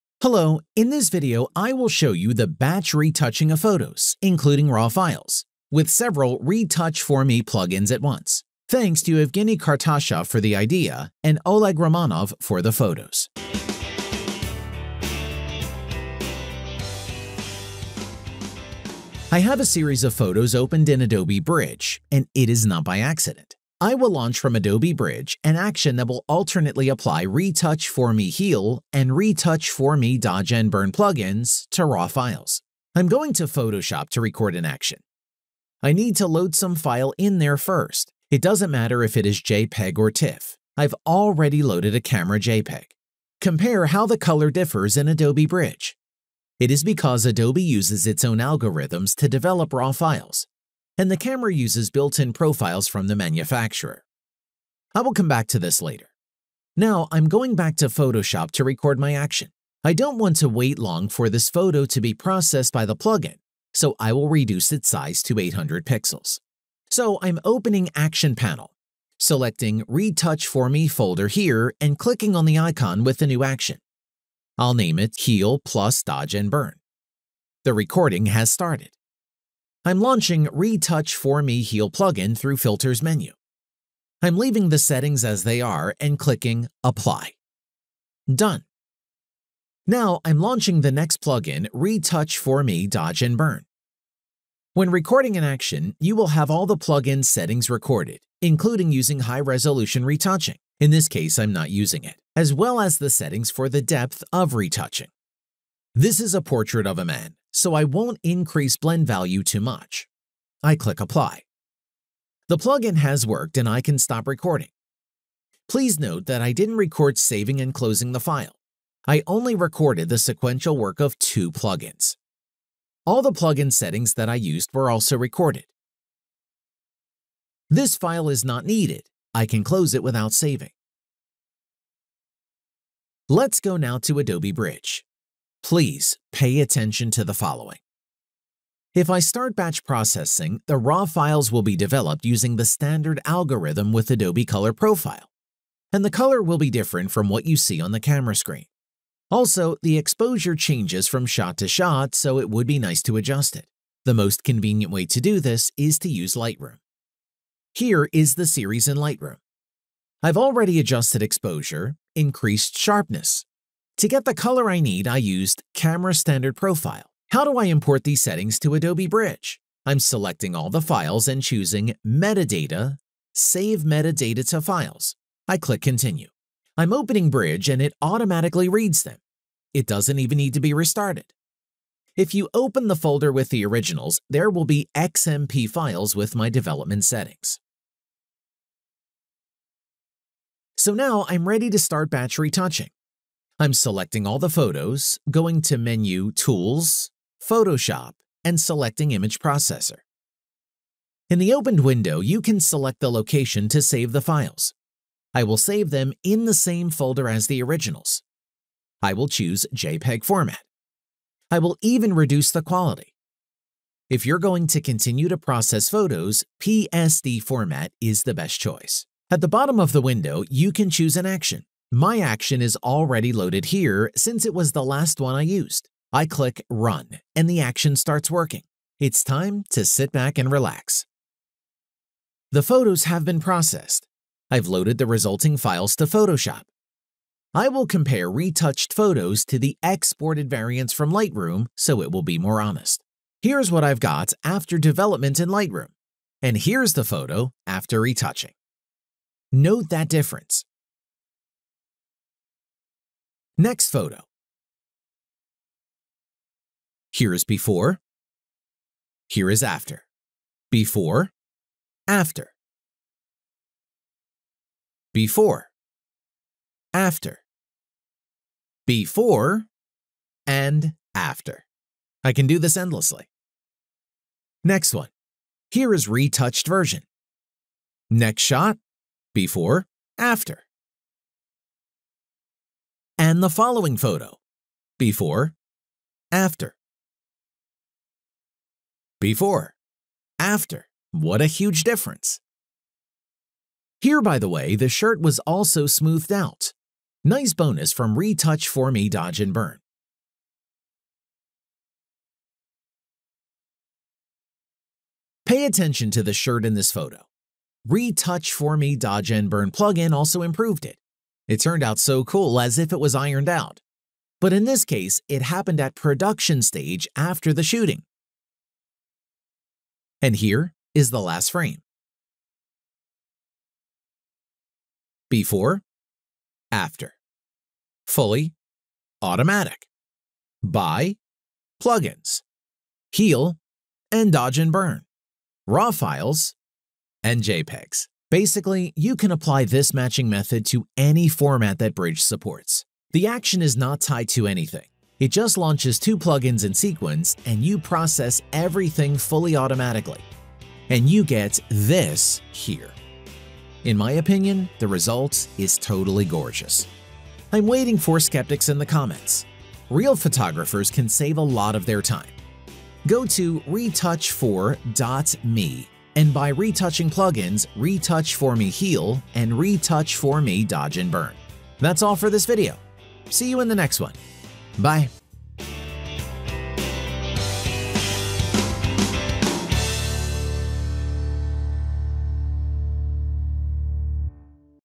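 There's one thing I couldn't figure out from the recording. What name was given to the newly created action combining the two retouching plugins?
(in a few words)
Heal plus Dodge and Burn.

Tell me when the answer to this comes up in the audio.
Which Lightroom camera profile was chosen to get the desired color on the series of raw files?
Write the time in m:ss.
2:45.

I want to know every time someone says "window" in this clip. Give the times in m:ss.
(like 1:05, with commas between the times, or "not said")
3:21, 3:40.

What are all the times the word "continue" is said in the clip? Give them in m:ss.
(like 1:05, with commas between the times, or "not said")
2:55, 3:34.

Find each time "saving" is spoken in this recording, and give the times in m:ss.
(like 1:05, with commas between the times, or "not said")
1:57, 2:10.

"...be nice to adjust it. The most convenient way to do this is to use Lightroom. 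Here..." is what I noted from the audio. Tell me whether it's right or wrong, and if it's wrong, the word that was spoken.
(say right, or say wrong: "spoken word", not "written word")
right.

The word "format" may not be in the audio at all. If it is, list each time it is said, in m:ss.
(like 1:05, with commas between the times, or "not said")
3:30, 3:37, 5:41.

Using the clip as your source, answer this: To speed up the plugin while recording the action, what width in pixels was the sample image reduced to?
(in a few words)
800.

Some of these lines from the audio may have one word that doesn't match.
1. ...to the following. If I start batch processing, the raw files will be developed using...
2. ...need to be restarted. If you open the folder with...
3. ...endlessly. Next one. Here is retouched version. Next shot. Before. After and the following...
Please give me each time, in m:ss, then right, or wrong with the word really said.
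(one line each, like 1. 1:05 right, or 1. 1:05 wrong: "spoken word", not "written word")
1. 2:17 right
2. 3:00 right
3. 4:32 right.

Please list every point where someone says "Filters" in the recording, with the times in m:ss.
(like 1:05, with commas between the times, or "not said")
1:22.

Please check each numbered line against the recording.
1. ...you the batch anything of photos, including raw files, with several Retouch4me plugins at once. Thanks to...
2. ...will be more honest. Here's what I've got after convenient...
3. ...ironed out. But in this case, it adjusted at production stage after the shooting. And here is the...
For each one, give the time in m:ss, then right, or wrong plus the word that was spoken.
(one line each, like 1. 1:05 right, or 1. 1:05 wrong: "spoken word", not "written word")
1. 0:02 wrong: "retouching", not "anything"
2. 4:02 wrong: "development", not "convenient"
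3. 5:13 wrong: "happened", not "adjusted".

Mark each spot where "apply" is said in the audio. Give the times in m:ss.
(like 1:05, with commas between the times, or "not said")
0:26, 1:26, 1:50, 5:39.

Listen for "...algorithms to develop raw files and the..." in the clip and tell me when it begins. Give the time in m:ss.
0:48.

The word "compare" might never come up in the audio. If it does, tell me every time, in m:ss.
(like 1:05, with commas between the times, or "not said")
0:43, 3:57.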